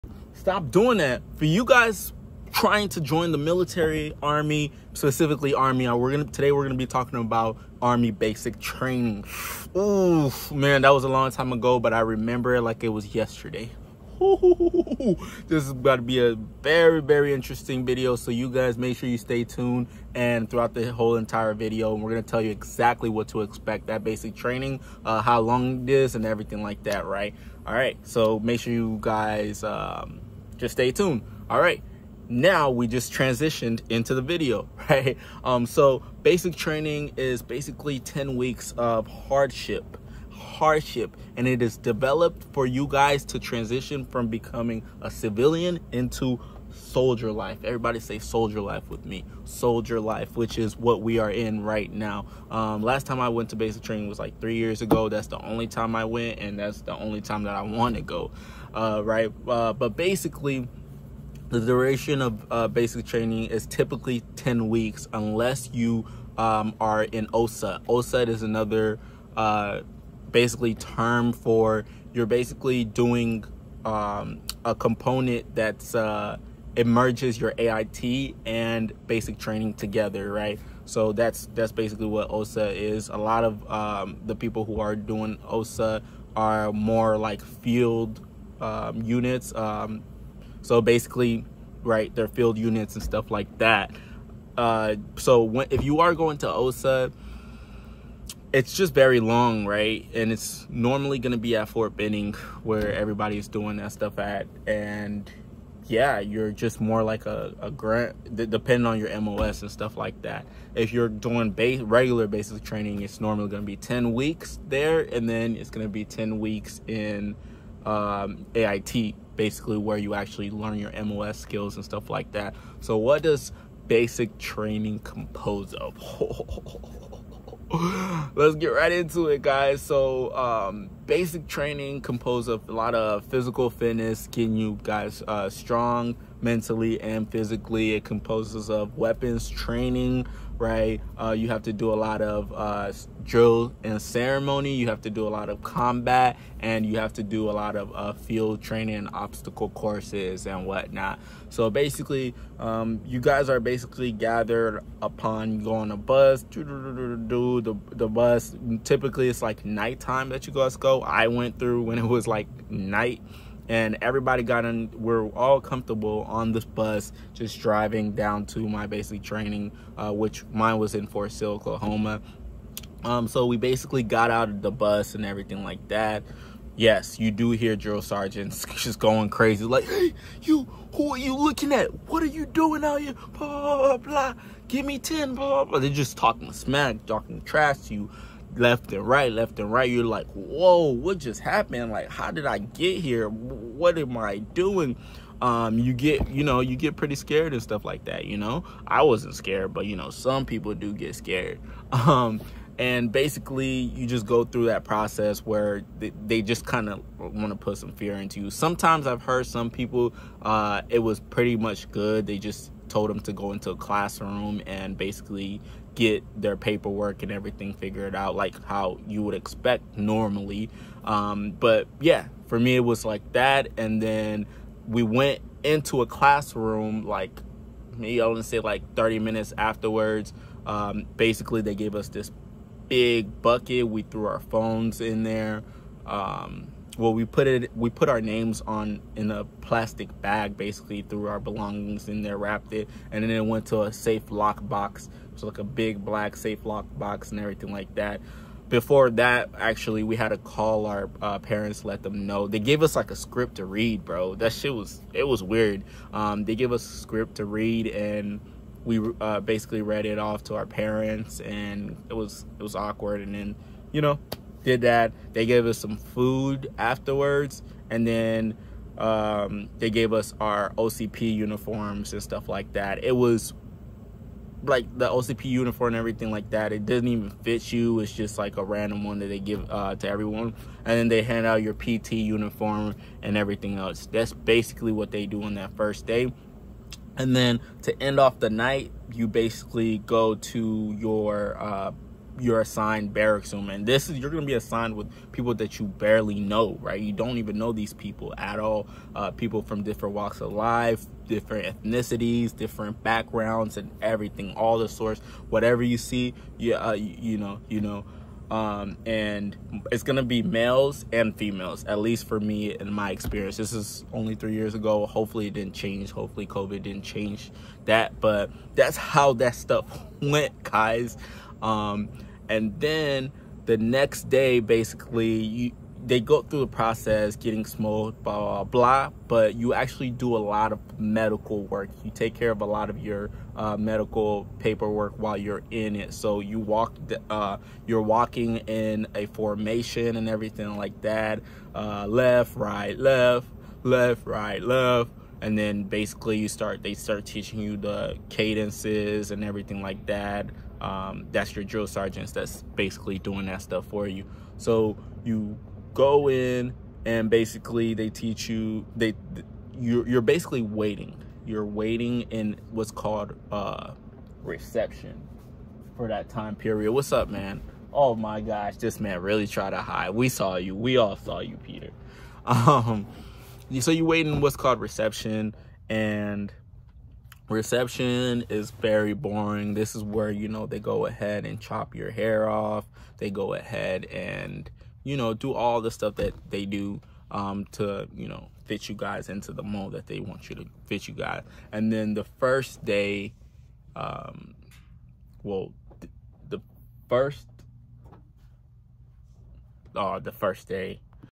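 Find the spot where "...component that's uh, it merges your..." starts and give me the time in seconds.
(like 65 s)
74 s.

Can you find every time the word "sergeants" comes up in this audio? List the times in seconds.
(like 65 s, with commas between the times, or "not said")
178 s, 351 s.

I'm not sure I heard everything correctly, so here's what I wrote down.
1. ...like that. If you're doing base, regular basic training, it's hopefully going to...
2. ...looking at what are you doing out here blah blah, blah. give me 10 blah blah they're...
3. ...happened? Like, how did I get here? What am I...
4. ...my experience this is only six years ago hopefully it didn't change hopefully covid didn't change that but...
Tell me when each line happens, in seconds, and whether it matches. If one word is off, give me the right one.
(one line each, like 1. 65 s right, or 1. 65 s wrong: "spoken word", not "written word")
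1. 109 s wrong: "normally", not "hopefully"
2. 181 s right
3. 191 s right
4. 312 s wrong: "three", not "six".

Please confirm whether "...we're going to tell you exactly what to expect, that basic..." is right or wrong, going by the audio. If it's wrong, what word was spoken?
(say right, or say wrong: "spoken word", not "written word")
right.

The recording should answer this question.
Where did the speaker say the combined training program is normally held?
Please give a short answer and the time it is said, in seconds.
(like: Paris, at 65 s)
Fort Benning, at 101 s.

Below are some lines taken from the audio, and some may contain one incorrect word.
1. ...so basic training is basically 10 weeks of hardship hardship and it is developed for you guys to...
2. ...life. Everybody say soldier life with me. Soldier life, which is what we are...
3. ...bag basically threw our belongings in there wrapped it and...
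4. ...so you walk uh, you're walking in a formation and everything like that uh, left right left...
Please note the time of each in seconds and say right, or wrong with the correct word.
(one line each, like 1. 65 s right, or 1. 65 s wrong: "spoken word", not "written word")
1. 35 s right
2. 47 s right
3. 240 s right
4. 336 s right.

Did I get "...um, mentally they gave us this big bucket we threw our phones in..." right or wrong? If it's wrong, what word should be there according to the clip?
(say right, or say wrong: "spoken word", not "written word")
wrong: "basically", not "mentally".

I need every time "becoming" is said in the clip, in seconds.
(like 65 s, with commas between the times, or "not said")
44 s.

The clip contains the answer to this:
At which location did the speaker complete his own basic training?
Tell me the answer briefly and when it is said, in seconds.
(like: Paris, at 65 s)
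Fort Sill, Oklahoma, at 171 s.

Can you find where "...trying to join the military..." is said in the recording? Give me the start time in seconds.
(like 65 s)
2 s.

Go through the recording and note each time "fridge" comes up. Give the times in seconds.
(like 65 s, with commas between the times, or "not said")
not said.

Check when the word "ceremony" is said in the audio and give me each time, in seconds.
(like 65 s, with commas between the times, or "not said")
144 s.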